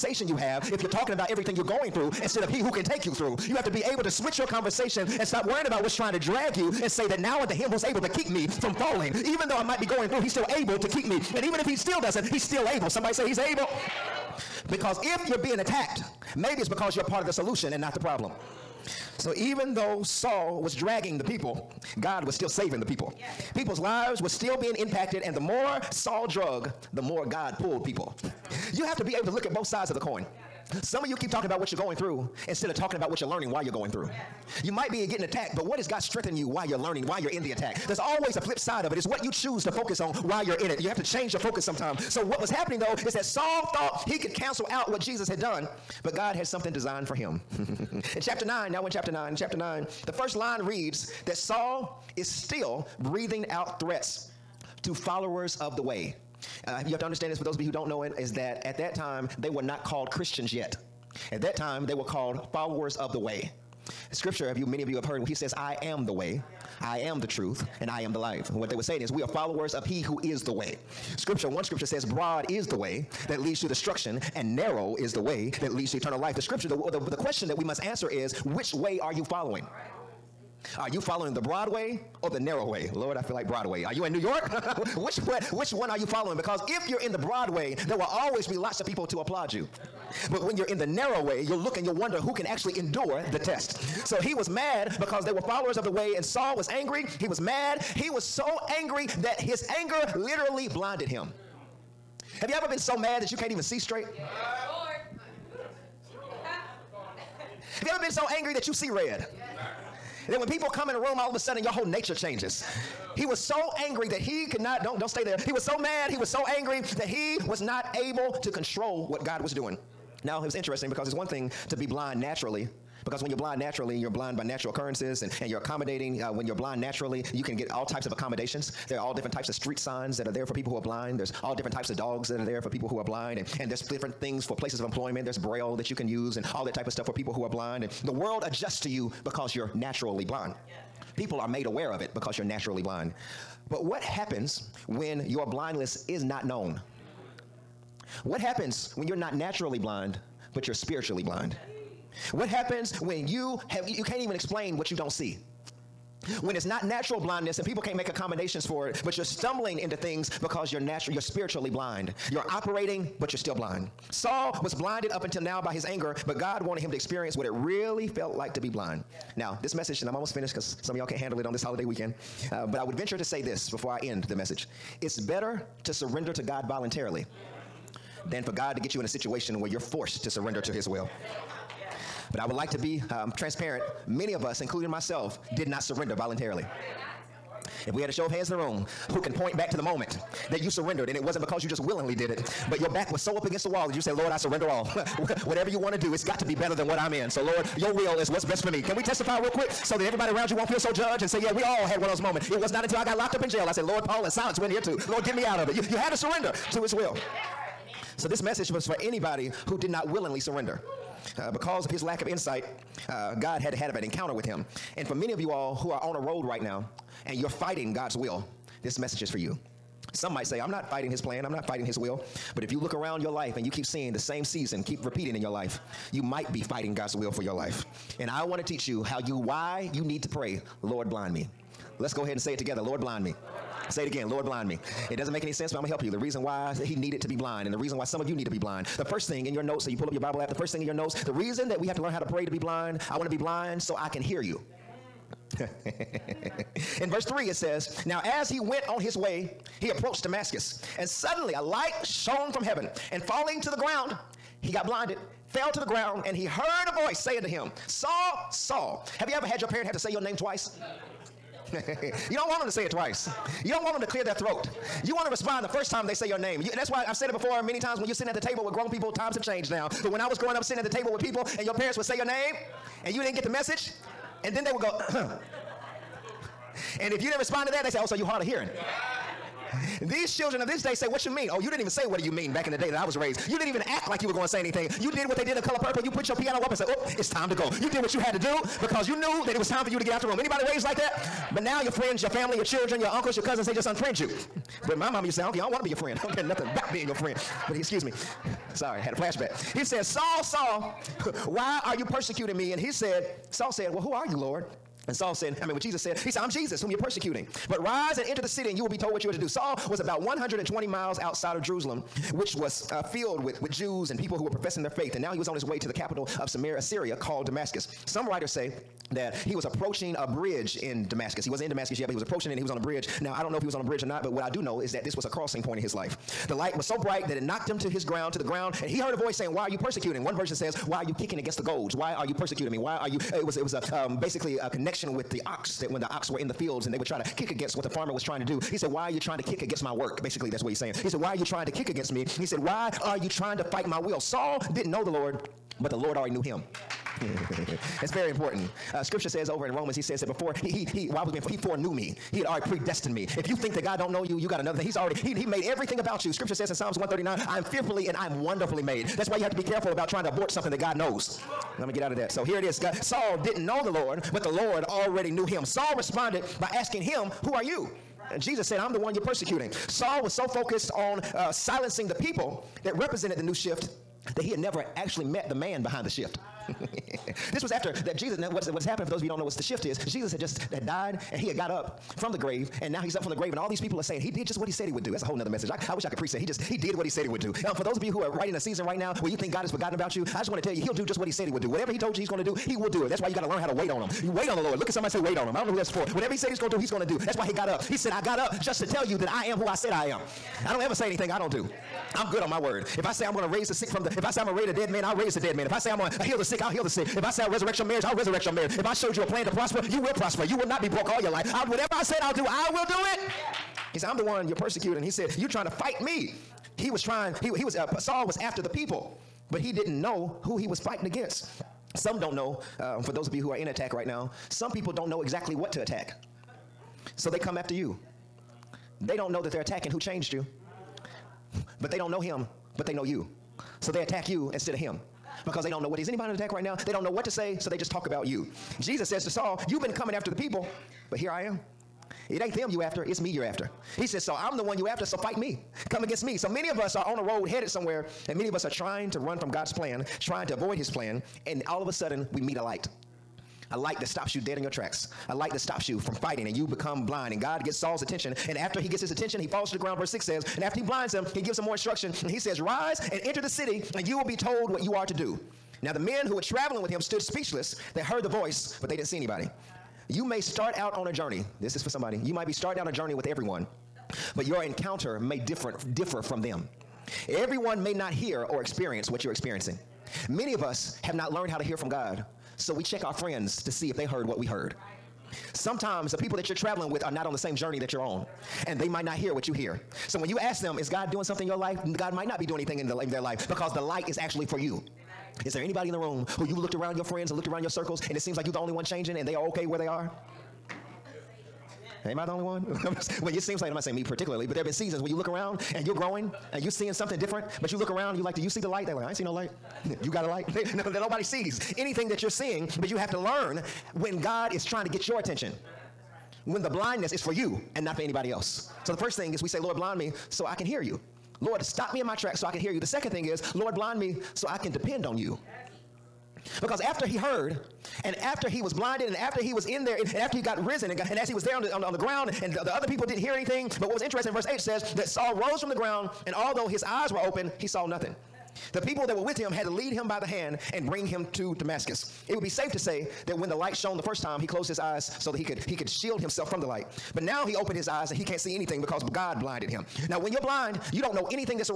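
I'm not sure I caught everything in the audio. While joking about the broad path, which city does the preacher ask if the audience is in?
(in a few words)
New York.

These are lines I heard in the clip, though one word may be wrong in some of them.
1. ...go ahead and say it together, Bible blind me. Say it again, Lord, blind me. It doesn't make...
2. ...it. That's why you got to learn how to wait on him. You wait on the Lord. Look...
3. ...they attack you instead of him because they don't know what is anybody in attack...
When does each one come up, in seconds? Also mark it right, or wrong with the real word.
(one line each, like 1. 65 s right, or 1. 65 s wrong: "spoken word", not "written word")
1. 232 s wrong: "Lord", not "Bible"
2. 393 s right
3. 433 s right.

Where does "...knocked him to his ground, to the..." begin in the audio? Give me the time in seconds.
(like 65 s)
327 s.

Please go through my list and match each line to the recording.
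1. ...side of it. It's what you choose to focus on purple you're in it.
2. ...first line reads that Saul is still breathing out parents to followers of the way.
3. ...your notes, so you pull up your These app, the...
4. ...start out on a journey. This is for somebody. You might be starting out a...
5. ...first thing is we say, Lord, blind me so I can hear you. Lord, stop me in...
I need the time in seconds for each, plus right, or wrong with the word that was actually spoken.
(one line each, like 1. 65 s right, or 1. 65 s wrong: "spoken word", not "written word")
1. 38 s wrong: "while", not "purple"
2. 50 s wrong: "threats", not "parents"
3. 239 s wrong: "Bible", not "These"
4. 470 s right
5. 518 s right.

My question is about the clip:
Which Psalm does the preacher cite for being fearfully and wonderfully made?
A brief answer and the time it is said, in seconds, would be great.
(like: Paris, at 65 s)
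Psalms 139, at 356 s.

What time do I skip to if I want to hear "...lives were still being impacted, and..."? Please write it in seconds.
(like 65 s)
23 s.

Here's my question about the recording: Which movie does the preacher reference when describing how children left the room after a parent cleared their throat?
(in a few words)
Color Purple.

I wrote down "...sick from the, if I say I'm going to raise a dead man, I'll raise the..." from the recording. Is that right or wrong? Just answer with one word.
right.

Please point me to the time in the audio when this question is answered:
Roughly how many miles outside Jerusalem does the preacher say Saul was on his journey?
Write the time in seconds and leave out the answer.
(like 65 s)
310 s.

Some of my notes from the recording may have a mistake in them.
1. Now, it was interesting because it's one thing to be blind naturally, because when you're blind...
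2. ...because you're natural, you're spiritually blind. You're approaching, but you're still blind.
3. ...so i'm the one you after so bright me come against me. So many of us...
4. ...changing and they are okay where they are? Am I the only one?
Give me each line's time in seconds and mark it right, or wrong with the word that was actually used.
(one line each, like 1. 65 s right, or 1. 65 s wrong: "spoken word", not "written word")
1. 120 s right
2. 160 s wrong: "operating", not "approaching"
3. 444 s wrong: "fight", not "bright"
4. 498 s right.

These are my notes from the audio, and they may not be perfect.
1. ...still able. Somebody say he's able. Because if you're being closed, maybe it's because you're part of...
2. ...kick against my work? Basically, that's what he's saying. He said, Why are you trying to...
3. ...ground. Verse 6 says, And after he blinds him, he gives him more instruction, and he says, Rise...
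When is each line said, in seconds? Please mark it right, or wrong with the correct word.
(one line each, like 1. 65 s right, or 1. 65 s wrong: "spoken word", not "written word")
1. 12 s wrong: "attacked", not "closed"
2. 339 s right
3. 459 s right.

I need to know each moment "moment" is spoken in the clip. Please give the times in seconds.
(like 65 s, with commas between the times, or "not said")
189 s, 202 s.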